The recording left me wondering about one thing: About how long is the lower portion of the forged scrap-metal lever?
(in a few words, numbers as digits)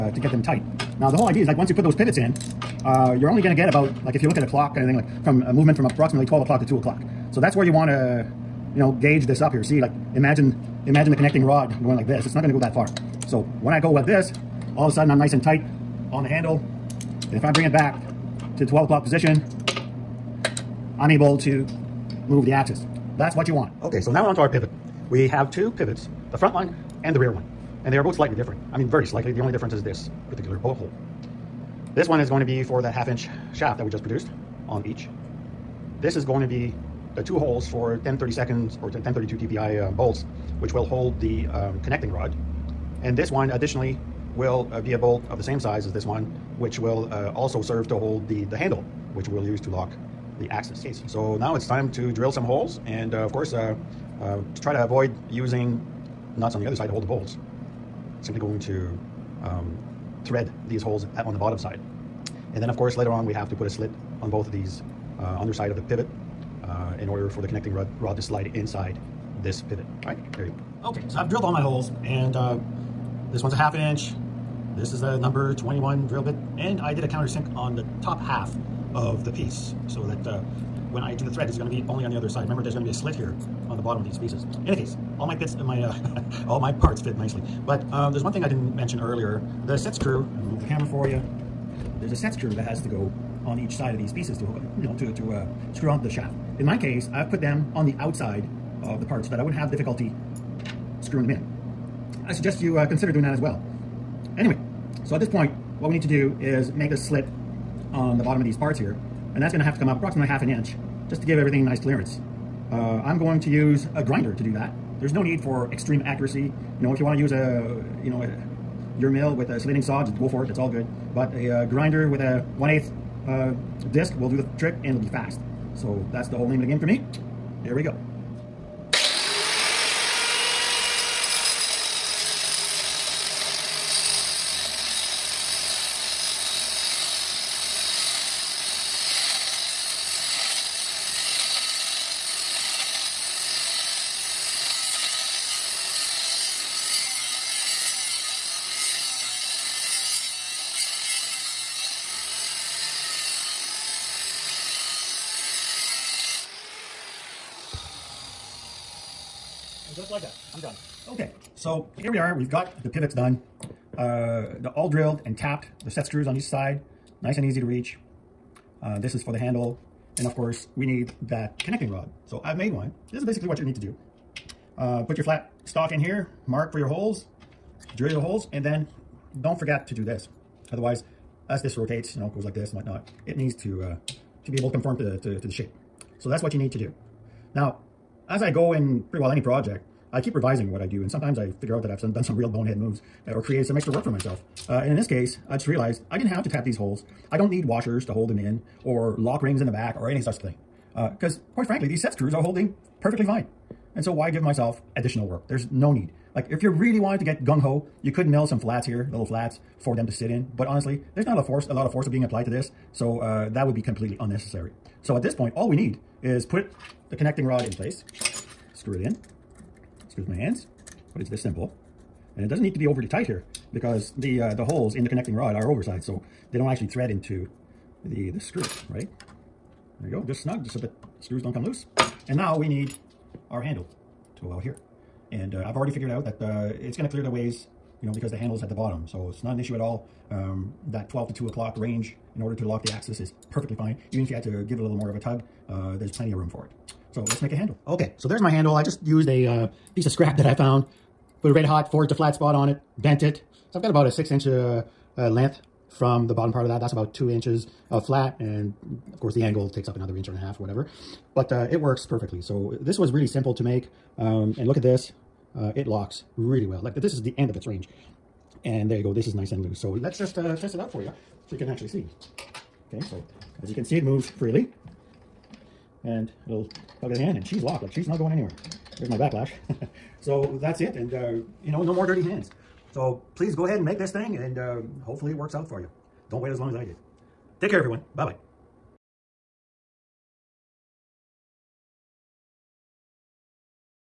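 6 inches.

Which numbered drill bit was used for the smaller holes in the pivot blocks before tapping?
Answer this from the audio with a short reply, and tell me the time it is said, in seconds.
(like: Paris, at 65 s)
Number 21, at 75 s.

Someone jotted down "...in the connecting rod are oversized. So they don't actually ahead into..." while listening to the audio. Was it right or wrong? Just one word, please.
wrong.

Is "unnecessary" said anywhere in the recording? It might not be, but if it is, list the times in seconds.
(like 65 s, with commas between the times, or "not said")
214 s.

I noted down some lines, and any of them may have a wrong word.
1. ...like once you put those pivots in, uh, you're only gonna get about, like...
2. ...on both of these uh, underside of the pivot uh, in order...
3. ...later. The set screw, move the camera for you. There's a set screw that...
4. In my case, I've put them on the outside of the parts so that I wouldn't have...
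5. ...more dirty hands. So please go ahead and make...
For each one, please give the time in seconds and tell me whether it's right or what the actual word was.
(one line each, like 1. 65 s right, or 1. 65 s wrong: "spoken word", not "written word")
1. 1 s right
2. 64 s right
3. 88 s wrong: "earlier", not "later"
4. 96 s right
5. 281 s right.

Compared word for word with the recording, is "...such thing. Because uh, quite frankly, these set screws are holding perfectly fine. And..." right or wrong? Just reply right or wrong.
right.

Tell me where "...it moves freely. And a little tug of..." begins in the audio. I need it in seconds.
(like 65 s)
273 s.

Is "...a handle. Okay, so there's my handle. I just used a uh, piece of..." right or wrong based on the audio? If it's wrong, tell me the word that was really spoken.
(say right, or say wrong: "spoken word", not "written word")
right.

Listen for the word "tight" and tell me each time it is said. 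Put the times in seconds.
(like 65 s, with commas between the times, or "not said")
0 s, 15 s, 223 s.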